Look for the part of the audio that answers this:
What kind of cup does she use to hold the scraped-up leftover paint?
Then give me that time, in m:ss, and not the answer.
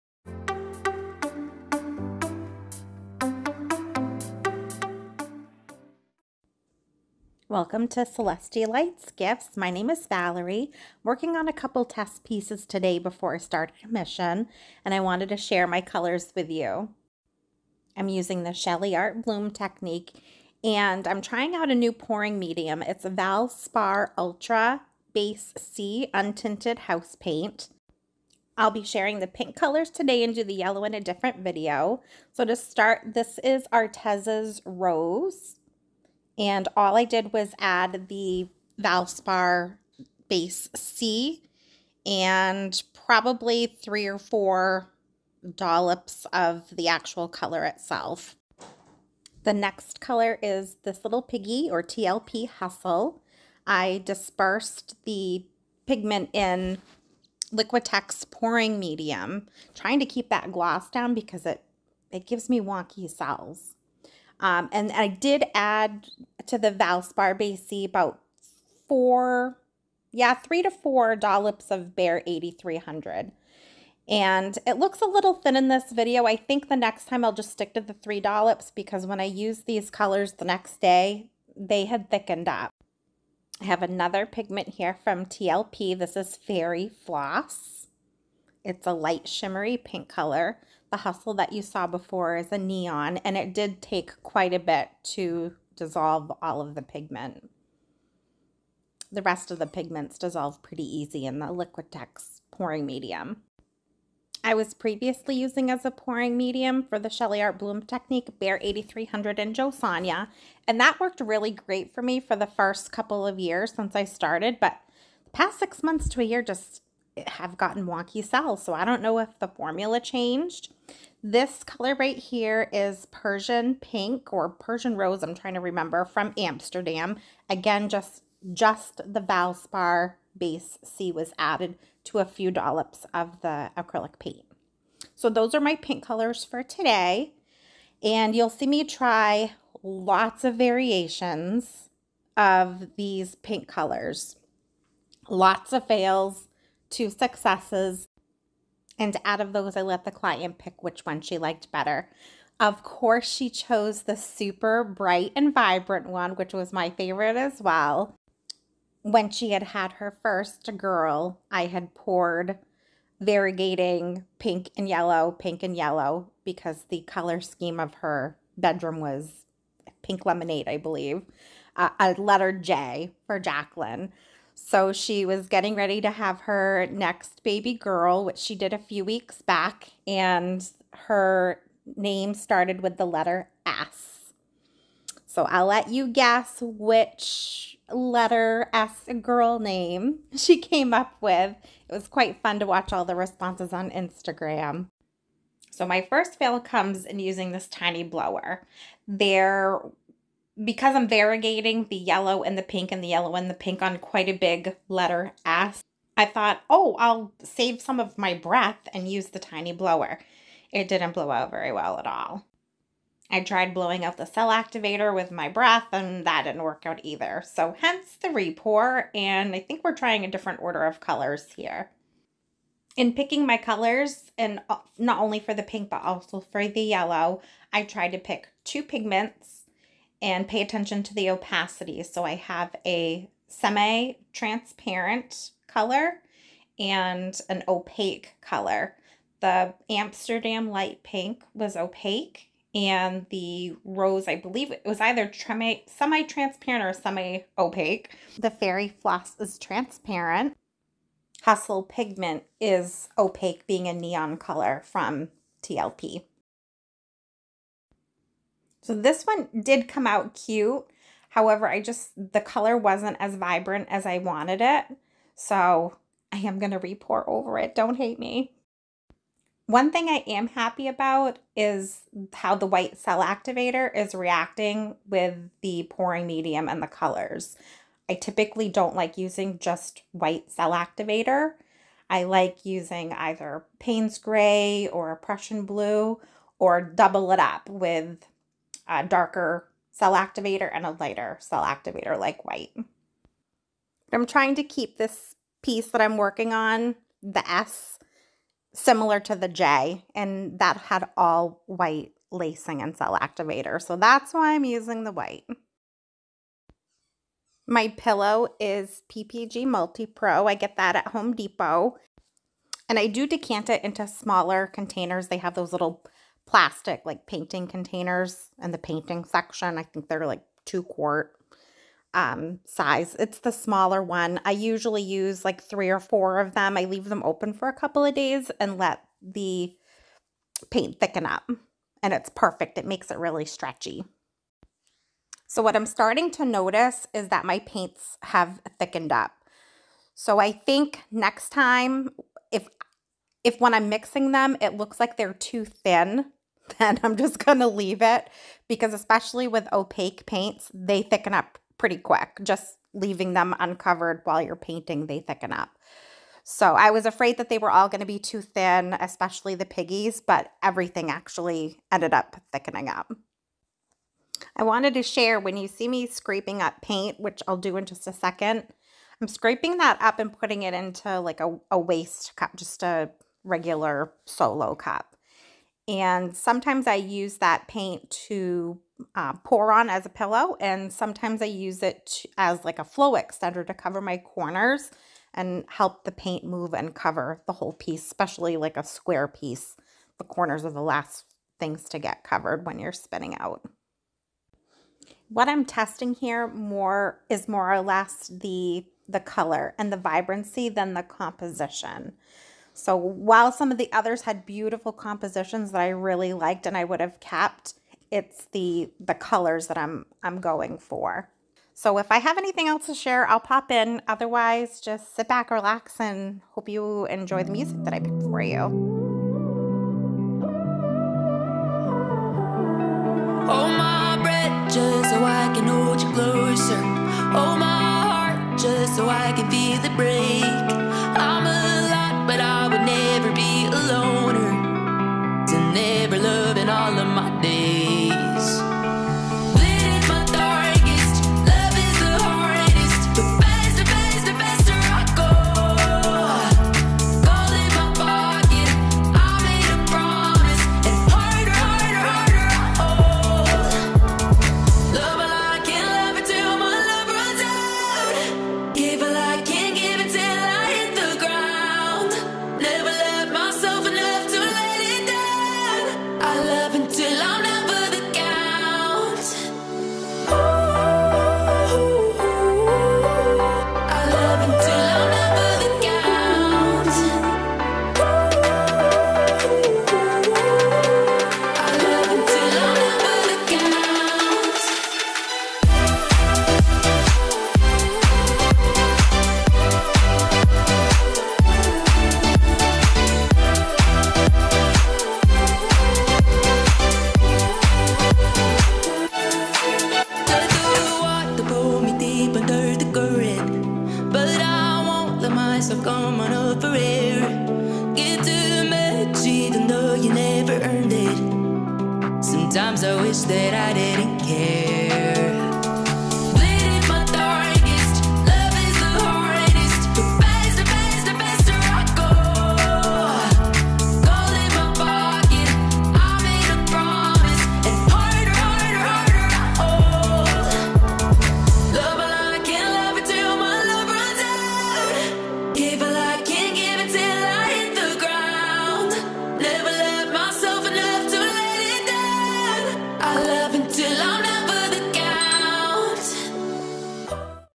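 6:14.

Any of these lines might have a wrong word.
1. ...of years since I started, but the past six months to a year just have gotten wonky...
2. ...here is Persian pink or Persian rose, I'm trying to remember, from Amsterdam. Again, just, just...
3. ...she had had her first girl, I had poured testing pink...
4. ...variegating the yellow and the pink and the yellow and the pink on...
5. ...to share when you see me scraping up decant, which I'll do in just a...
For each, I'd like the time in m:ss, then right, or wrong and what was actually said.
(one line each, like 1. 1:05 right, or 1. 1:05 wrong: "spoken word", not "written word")
1. 1:53 right
2. 2:02 right
3. 2:39 wrong: "variegating", not "testing"
4. 3:21 right
5. 6:04 wrong: "paint", not "decant".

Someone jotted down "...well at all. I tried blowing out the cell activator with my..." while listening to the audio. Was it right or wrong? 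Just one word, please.
right.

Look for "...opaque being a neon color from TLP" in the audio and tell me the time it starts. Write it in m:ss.
4:13.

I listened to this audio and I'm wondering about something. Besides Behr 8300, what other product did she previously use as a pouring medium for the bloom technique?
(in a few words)
Josonja.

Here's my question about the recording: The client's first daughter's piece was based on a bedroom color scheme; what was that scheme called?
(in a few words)
pink lemonade.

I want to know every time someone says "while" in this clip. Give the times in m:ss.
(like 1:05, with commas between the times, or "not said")
5:54, 6:42.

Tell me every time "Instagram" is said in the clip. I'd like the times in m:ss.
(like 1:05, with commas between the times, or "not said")
3:13.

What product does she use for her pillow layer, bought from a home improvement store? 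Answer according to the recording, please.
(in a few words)
PPG Multi Pro.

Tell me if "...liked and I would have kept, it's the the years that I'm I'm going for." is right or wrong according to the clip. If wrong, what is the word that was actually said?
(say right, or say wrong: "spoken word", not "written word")
wrong: "colors", not "years".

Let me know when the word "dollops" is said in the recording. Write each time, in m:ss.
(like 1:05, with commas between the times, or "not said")
0:45, 1:11, 1:18, 2:12.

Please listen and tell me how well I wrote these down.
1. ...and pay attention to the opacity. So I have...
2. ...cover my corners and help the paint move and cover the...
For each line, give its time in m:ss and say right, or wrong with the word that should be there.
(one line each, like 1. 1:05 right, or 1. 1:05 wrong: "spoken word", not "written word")
1. 3:50 right
2. 6:23 right.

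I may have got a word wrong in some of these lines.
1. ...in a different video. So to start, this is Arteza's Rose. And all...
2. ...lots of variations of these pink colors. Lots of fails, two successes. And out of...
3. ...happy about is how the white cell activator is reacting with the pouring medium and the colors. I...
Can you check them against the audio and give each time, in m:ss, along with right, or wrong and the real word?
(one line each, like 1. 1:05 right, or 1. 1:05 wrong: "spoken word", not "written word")
1. 0:30 right
2. 2:19 right
3. 4:30 right.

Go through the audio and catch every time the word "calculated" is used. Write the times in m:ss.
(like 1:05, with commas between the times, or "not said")
not said.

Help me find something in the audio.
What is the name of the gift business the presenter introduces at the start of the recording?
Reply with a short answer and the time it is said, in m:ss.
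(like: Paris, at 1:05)
Celestial Lites Gifts, at 0:08.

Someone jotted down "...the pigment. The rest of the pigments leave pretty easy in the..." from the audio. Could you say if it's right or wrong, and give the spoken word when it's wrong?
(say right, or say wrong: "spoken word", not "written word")
wrong: "dissolve", not "leave".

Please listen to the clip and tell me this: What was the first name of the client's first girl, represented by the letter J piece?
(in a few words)
Jacqueline.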